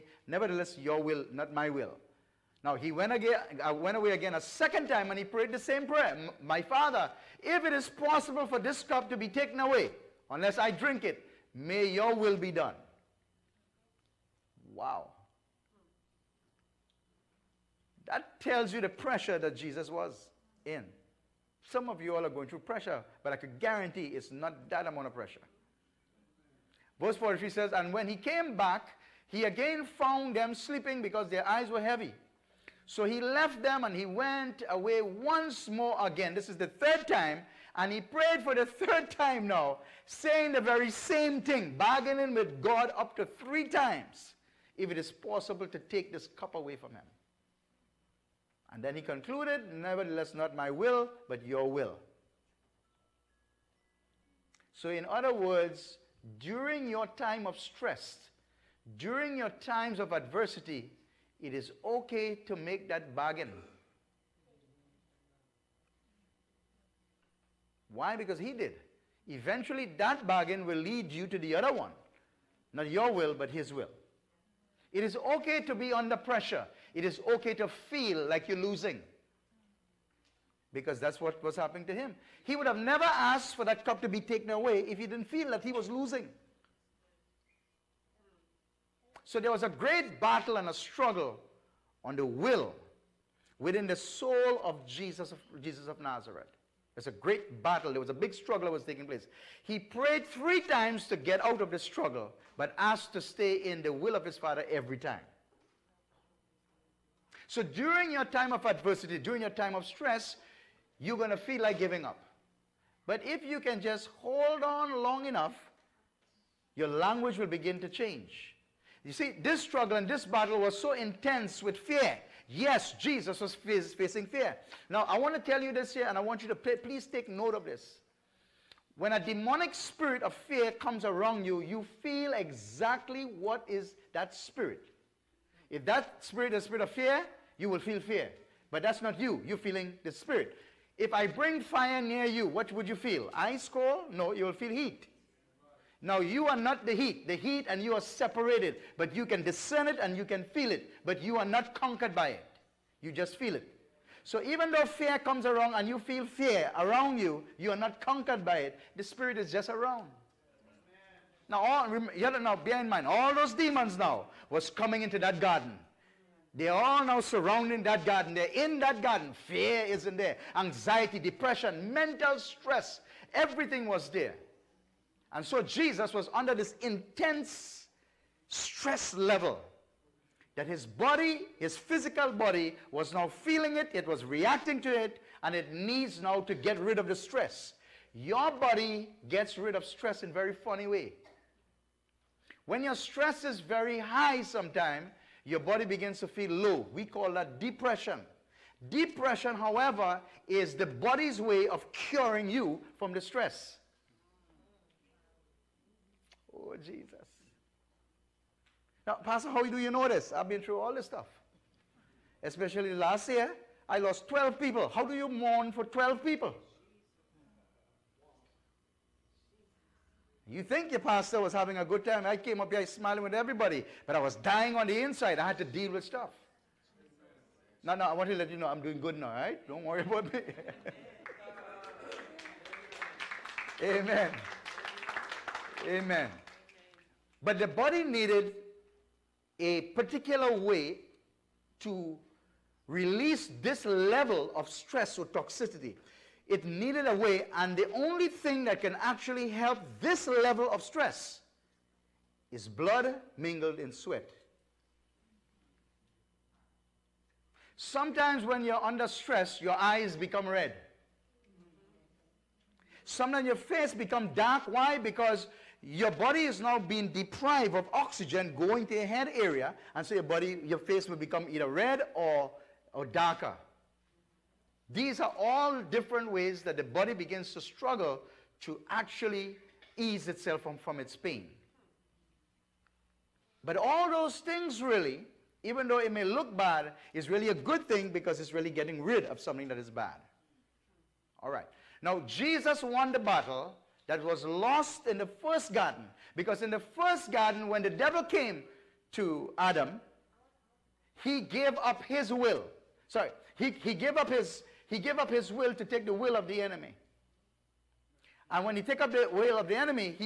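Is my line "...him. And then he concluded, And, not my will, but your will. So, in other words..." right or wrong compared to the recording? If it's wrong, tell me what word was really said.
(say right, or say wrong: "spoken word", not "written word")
wrong: "Nevertheless", not "And".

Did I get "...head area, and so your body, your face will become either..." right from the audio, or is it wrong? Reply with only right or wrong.
right.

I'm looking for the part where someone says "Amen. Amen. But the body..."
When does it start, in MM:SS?
03:53.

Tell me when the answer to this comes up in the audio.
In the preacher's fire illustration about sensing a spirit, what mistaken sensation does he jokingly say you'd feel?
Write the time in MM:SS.
02:23.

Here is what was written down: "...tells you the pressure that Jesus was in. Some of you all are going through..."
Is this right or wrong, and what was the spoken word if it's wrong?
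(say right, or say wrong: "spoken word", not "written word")
right.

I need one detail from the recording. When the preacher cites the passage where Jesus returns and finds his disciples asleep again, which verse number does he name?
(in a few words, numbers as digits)
Verse 43.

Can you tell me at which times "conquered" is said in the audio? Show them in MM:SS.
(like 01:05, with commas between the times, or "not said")
02:31, 02:38.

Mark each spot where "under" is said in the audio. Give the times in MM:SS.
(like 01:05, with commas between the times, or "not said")
01:15, 02:56, 04:18.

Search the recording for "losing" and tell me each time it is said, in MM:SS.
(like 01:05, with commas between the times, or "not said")
01:18, 01:25.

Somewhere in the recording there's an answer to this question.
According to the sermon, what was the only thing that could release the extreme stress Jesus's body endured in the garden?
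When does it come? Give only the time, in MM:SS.
04:12.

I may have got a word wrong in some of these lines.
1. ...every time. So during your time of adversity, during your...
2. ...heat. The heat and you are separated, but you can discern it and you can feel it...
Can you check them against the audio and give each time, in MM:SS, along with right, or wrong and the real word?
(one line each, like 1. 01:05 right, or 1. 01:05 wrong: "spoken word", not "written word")
1. 01:44 right
2. 02:26 right.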